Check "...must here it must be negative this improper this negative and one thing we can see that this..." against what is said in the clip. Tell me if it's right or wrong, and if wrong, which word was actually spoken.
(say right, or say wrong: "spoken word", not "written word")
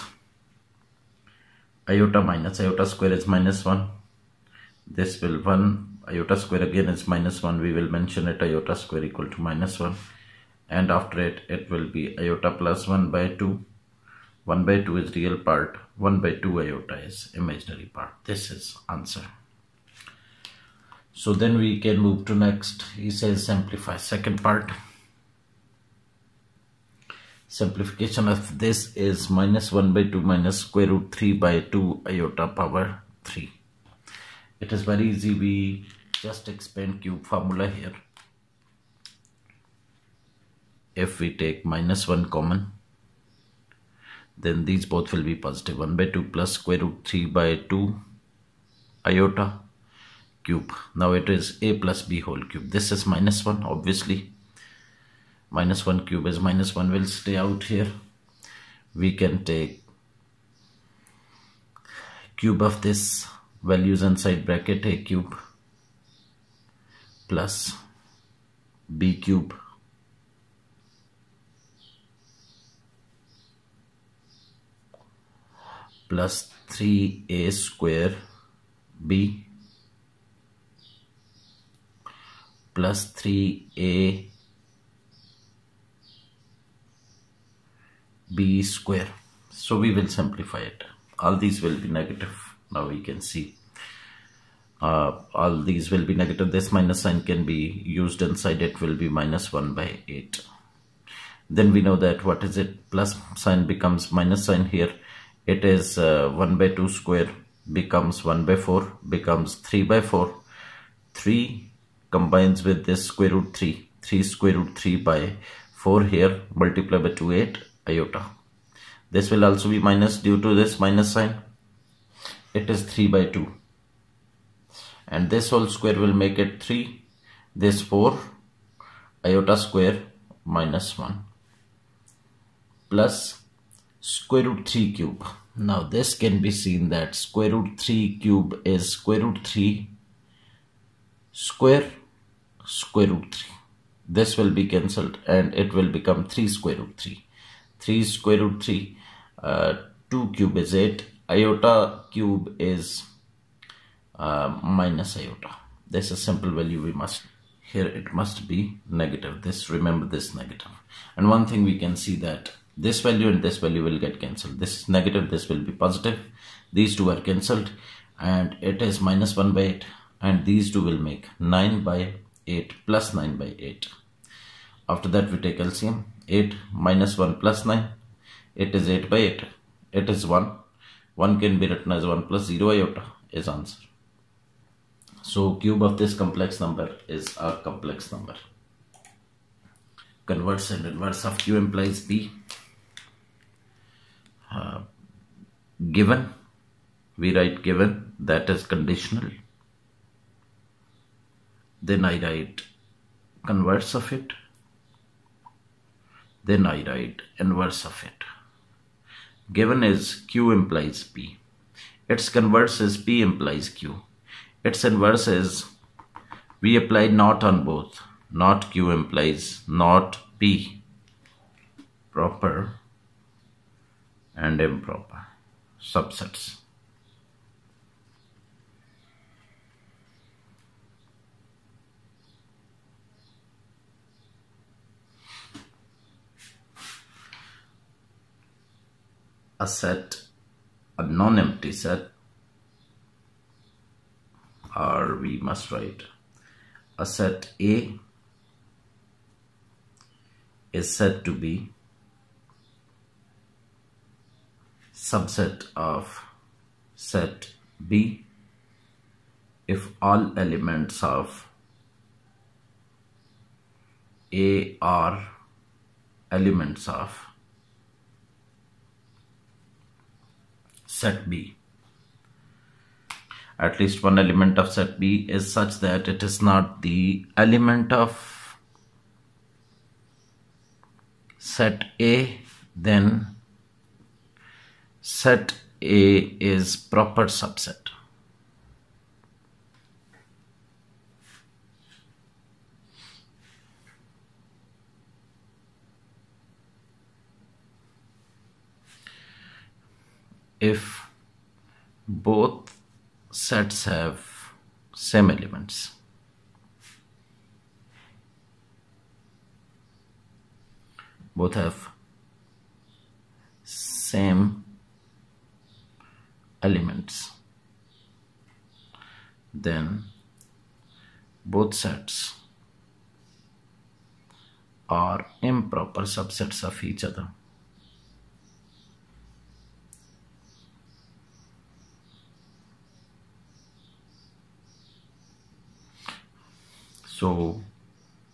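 wrong: "remember", not "improper".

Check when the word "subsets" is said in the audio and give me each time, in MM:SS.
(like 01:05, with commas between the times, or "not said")
03:45, 04:14, 04:47, 05:26.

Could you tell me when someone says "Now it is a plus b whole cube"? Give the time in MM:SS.
00:50.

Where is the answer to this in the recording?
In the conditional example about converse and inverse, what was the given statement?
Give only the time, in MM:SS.
03:29.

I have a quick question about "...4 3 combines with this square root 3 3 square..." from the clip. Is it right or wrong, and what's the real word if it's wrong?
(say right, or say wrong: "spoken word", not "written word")
right.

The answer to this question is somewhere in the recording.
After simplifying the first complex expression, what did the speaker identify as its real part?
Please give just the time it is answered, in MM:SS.
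00:14.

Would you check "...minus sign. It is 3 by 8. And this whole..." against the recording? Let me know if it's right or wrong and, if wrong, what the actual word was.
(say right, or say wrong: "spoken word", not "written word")
wrong: "2", not "8".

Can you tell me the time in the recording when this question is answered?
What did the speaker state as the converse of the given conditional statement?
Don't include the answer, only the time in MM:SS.
03:32.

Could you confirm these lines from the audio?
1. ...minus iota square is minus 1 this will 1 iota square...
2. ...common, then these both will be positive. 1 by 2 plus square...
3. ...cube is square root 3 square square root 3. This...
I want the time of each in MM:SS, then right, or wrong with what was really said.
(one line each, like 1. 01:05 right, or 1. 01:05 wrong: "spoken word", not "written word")
1. 00:02 right
2. 00:42 right
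3. 02:18 right.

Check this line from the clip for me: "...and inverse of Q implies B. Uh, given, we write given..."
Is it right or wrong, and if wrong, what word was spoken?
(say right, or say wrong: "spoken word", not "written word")
right.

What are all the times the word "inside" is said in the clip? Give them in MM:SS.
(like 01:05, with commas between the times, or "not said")
01:04, 01:38.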